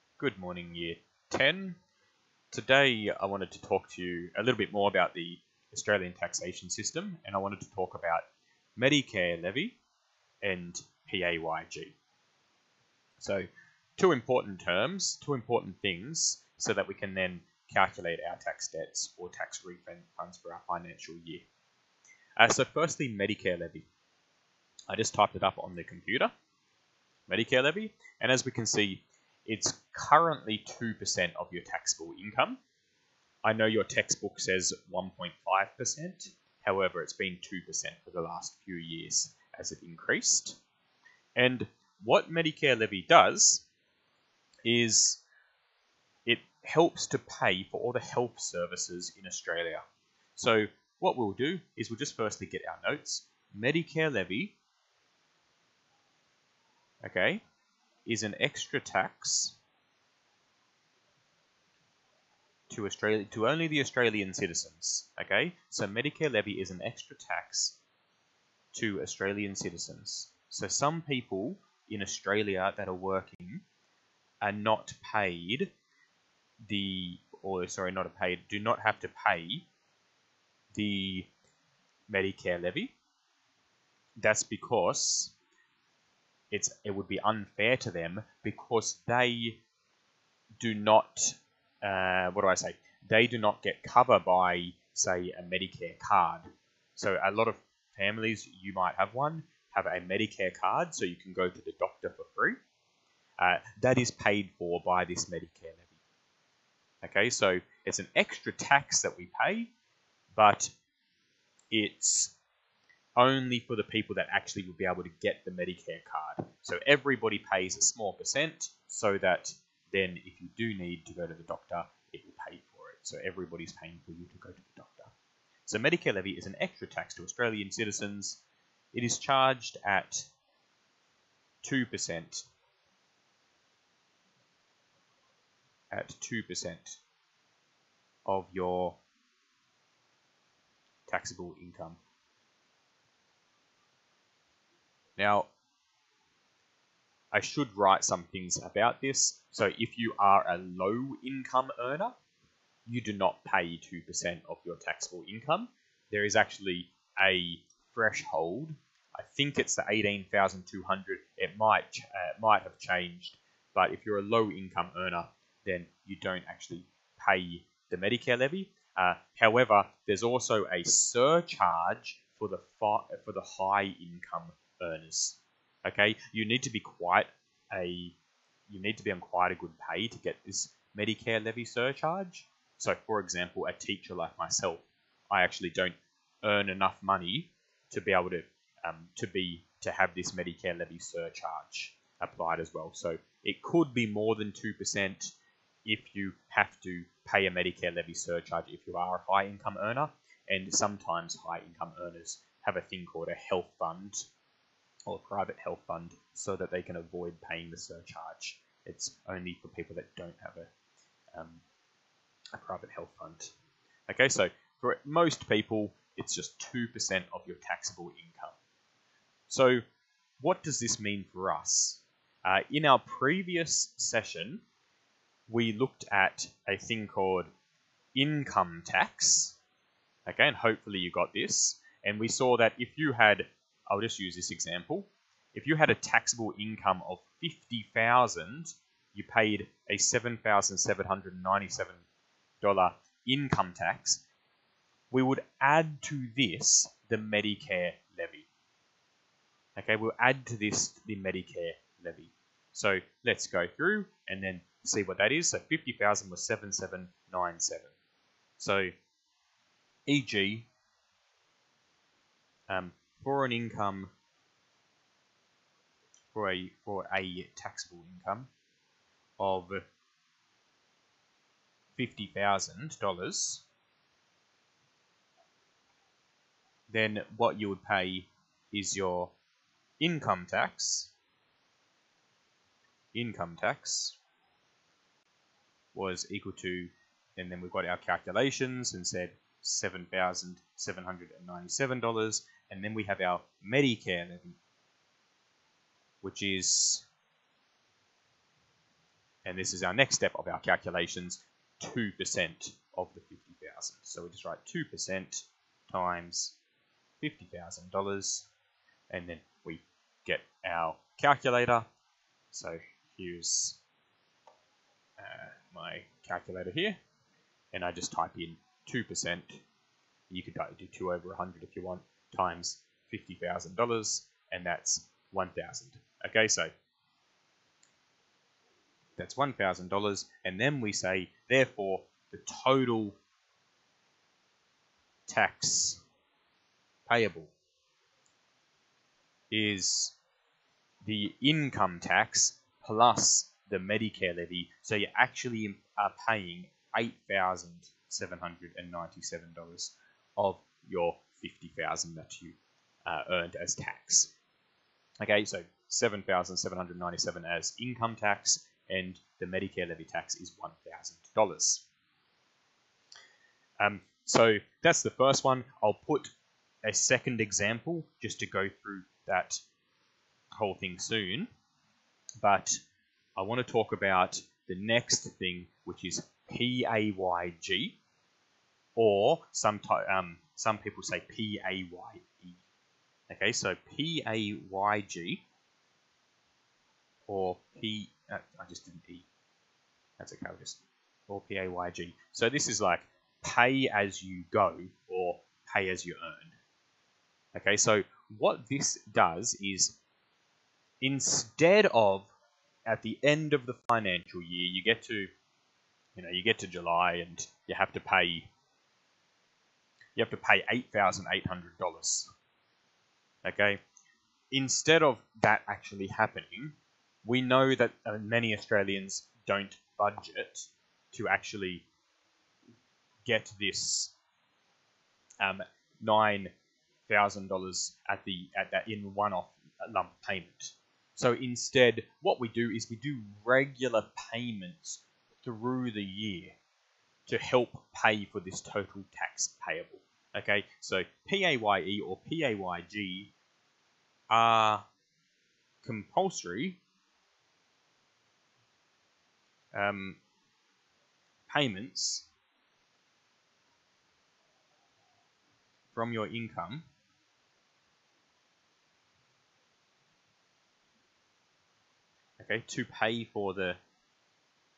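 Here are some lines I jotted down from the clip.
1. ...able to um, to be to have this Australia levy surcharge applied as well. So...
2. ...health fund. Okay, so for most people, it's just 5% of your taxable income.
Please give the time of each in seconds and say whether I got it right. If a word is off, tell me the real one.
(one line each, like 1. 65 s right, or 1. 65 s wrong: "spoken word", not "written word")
1. 188 s wrong: "Medicare", not "Australia"
2. 212 s wrong: "2", not "5".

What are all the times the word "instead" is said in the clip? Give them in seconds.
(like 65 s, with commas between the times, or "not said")
401 s, 414 s, 431 s.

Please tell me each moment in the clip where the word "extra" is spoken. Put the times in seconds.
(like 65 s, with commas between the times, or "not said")
58 s, 66 s, 108 s, 126 s.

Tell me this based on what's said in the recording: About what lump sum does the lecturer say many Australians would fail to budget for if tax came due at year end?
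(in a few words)
9,000.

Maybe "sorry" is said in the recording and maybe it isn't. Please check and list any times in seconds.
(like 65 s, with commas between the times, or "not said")
77 s.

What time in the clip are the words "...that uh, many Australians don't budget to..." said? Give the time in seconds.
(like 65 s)
417 s.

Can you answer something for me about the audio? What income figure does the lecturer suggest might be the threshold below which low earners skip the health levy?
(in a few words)
18,200.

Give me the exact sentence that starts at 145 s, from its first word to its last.
Now, I should write some things about this.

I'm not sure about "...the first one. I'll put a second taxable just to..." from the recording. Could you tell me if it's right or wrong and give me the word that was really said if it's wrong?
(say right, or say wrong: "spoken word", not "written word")
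wrong: "example", not "taxable".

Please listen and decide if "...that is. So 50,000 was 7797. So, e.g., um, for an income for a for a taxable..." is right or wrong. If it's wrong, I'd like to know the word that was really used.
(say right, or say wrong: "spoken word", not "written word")
right.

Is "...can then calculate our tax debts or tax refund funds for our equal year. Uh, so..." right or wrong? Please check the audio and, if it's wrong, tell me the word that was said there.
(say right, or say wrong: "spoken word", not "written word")
wrong: "financial", not "equal".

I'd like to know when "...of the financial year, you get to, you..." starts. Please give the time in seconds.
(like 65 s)
403 s.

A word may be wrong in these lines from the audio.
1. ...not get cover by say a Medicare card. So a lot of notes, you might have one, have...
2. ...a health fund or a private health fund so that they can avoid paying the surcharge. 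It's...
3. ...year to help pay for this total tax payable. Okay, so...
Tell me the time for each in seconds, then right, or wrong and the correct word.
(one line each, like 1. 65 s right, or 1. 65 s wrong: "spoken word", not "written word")
1. 93 s wrong: "families", not "notes"
2. 203 s right
3. 436 s right.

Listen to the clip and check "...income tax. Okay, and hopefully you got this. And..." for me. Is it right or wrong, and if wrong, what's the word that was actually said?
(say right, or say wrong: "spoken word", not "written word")
right.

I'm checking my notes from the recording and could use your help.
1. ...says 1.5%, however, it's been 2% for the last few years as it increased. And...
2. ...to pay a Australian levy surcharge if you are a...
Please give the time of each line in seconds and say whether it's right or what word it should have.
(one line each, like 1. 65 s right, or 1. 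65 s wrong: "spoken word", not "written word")
1. 34 s right
2. 196 s wrong: "Medicare", not "Australian".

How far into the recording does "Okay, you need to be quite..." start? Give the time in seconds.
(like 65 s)
175 s.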